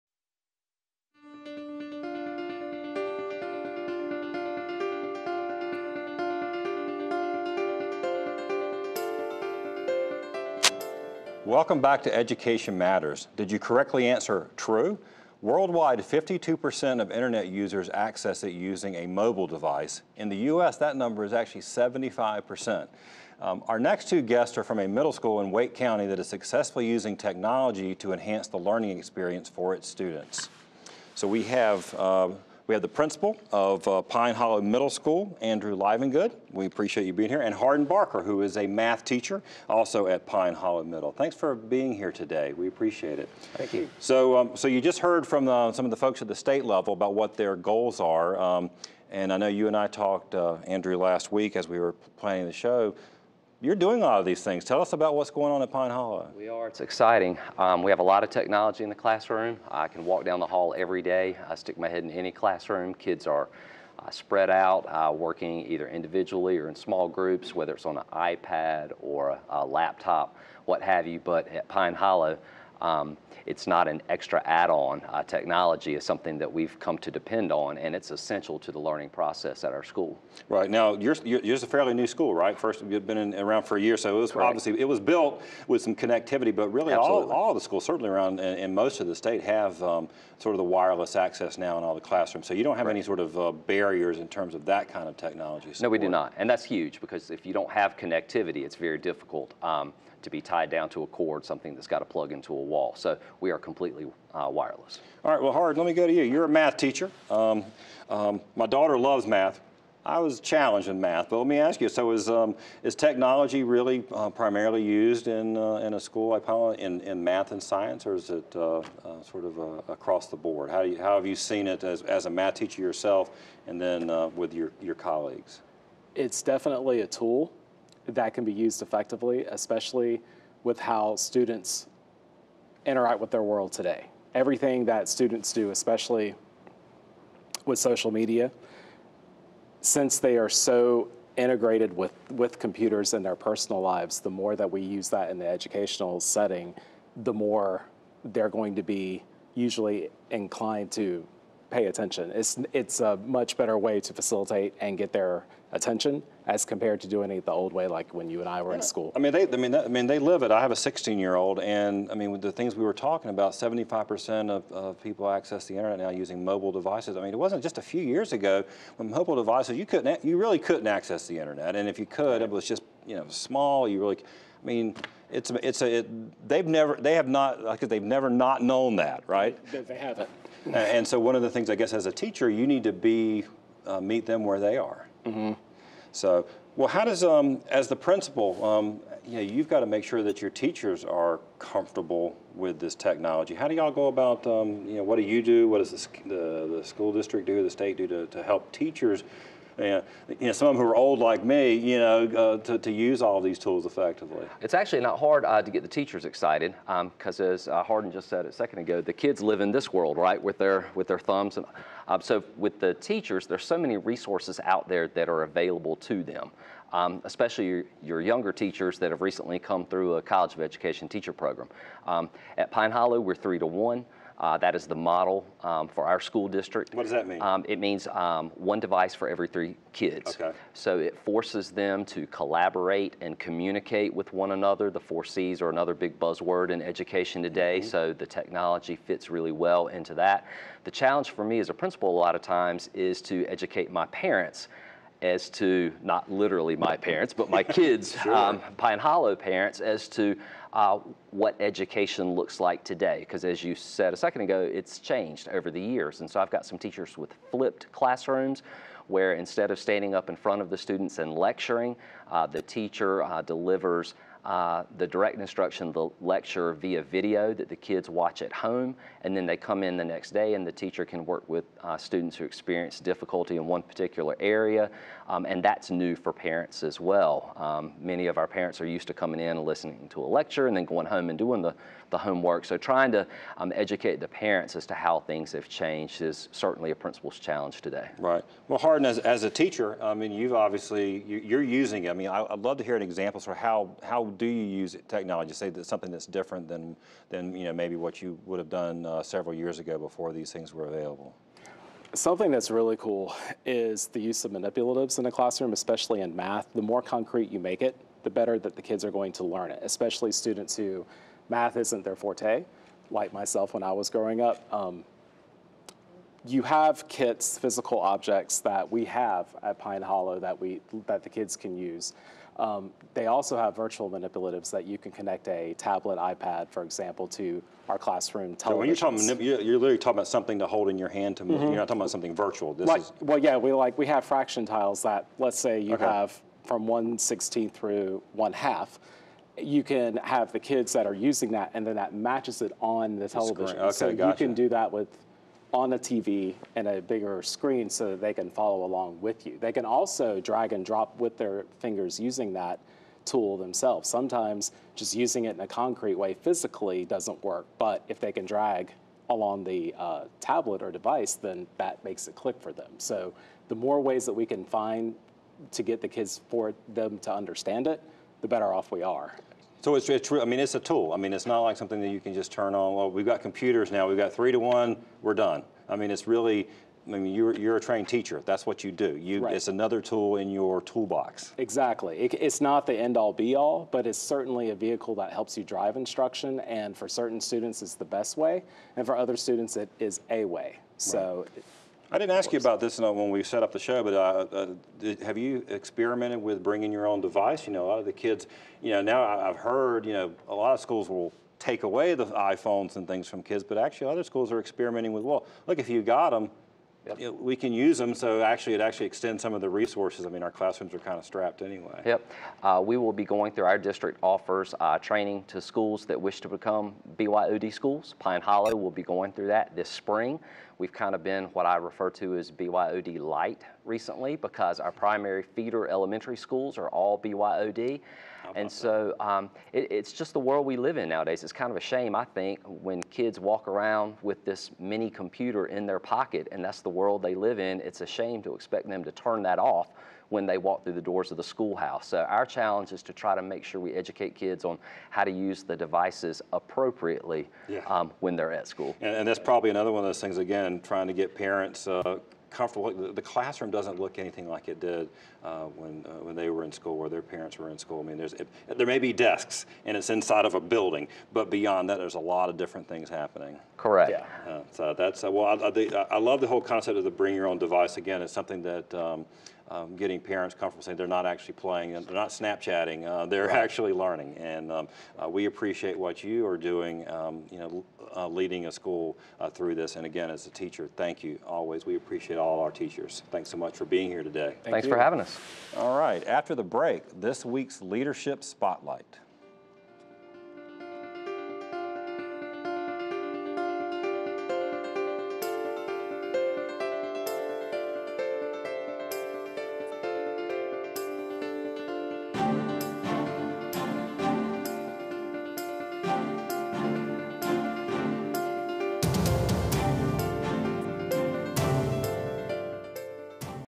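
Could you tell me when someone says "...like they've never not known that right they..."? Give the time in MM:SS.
02:57.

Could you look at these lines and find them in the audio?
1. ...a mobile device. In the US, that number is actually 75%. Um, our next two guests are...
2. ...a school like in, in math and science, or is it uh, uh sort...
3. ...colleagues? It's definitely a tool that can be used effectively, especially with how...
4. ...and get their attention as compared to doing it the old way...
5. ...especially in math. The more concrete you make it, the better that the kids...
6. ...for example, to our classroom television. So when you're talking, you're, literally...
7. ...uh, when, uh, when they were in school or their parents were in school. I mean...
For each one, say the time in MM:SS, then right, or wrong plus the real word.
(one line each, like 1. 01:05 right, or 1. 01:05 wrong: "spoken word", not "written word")
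1. 00:18 right
2. 01:55 right
3. 02:04 right
4. 02:34 right
5. 05:05 right
6. 05:26 right
7. 07:35 right.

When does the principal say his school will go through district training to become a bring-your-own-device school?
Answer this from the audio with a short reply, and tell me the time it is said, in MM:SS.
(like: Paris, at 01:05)
This spring, at 06:59.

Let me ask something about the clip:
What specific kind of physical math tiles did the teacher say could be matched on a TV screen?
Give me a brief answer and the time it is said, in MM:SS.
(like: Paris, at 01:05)
Fraction tiles, at 05:34.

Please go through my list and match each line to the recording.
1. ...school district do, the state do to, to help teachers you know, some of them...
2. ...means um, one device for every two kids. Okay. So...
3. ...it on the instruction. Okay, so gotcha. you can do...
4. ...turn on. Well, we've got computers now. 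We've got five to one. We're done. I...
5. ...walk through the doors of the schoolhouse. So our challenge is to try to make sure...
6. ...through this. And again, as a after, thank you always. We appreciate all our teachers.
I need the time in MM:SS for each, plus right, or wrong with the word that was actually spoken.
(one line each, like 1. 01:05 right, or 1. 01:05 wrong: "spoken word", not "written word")
1. 03:16 right
2. 03:47 wrong: "three", not "two"
3. 05:42 wrong: "television", not "instruction"
4. 06:12 wrong: "three", not "five"
5. 07:20 right
6. 07:59 wrong: "teacher", not "after".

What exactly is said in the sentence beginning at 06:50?
I mean, our classrooms are kind of strapped anyway.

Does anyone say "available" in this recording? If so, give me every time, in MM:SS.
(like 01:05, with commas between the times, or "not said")
03:35, 05:00.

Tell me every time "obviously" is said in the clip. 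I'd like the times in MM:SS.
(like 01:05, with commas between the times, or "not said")
01:24, 04:50.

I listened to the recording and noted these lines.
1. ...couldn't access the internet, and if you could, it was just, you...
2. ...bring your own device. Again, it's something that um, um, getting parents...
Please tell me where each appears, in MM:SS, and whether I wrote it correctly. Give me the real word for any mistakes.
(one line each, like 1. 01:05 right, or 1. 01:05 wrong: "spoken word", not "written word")
1. 02:50 right
2. 07:47 right.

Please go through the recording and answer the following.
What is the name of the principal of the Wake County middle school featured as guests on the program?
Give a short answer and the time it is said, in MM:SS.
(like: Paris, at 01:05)
Andrew Livingood, at 00:35.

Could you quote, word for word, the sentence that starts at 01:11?
But at Pine Hollow, um, it's not an extra add-on.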